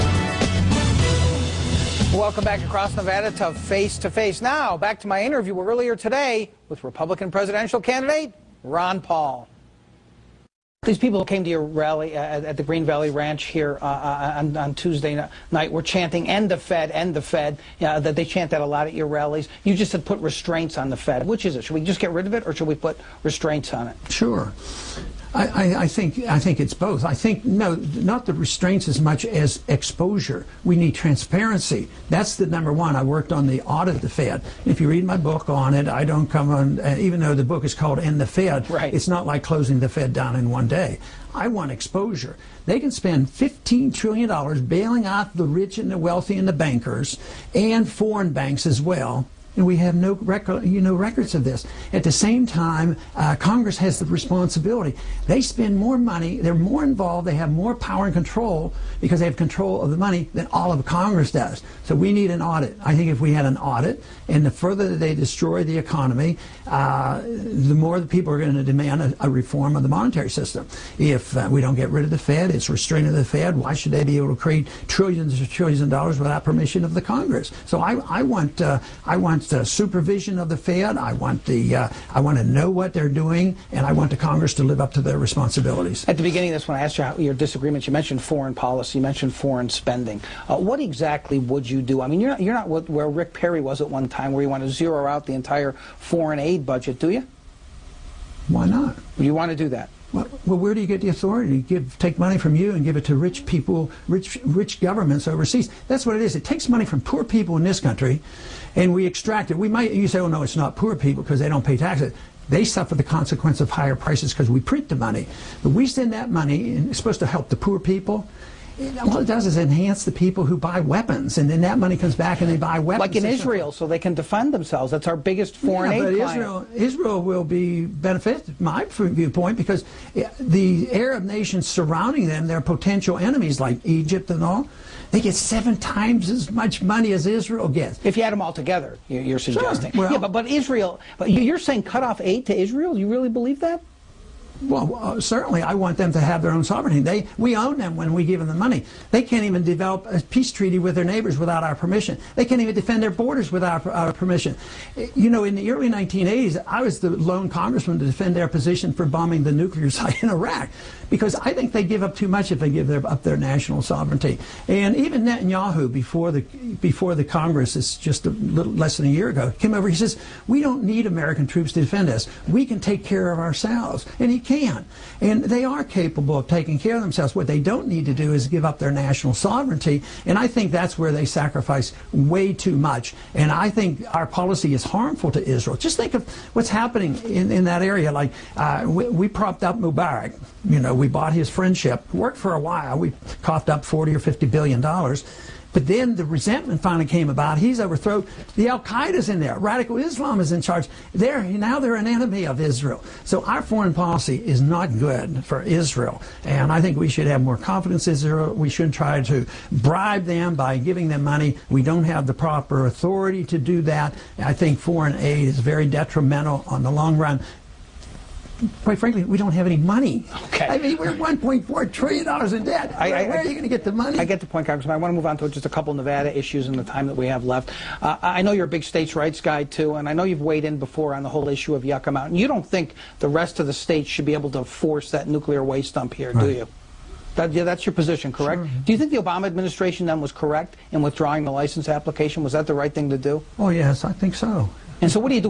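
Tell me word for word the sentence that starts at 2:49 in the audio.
He says, "We don't need American troops to defend us.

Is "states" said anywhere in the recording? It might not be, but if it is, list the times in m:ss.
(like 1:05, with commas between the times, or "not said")
3:48, 3:53.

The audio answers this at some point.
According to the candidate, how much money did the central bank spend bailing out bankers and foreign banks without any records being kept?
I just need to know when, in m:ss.
0:43.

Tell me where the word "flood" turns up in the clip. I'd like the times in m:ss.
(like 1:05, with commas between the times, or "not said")
not said.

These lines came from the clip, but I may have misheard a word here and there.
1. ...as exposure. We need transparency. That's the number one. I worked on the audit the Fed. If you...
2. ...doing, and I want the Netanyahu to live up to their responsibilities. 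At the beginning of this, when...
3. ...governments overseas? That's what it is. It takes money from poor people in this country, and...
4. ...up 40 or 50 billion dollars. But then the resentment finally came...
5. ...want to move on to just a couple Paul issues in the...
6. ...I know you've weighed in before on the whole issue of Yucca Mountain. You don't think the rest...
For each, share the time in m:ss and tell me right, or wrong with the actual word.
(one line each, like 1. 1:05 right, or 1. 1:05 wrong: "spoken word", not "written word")
1. 0:29 right
2. 1:23 wrong: "Congress", not "Netanyahu"
3. 1:44 right
4. 3:13 right
5. 3:44 wrong: "Nevada", not "Paul"
6. 3:50 right.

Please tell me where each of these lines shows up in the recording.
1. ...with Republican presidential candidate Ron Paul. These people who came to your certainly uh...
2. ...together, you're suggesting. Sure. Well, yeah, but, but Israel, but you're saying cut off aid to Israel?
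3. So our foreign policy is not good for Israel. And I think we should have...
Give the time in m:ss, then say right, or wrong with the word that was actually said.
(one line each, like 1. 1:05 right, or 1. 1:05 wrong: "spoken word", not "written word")
1. 0:06 wrong: "rally", not "certainly"
2. 2:18 right
3. 3:23 right.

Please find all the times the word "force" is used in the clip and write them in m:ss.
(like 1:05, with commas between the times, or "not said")
3:54.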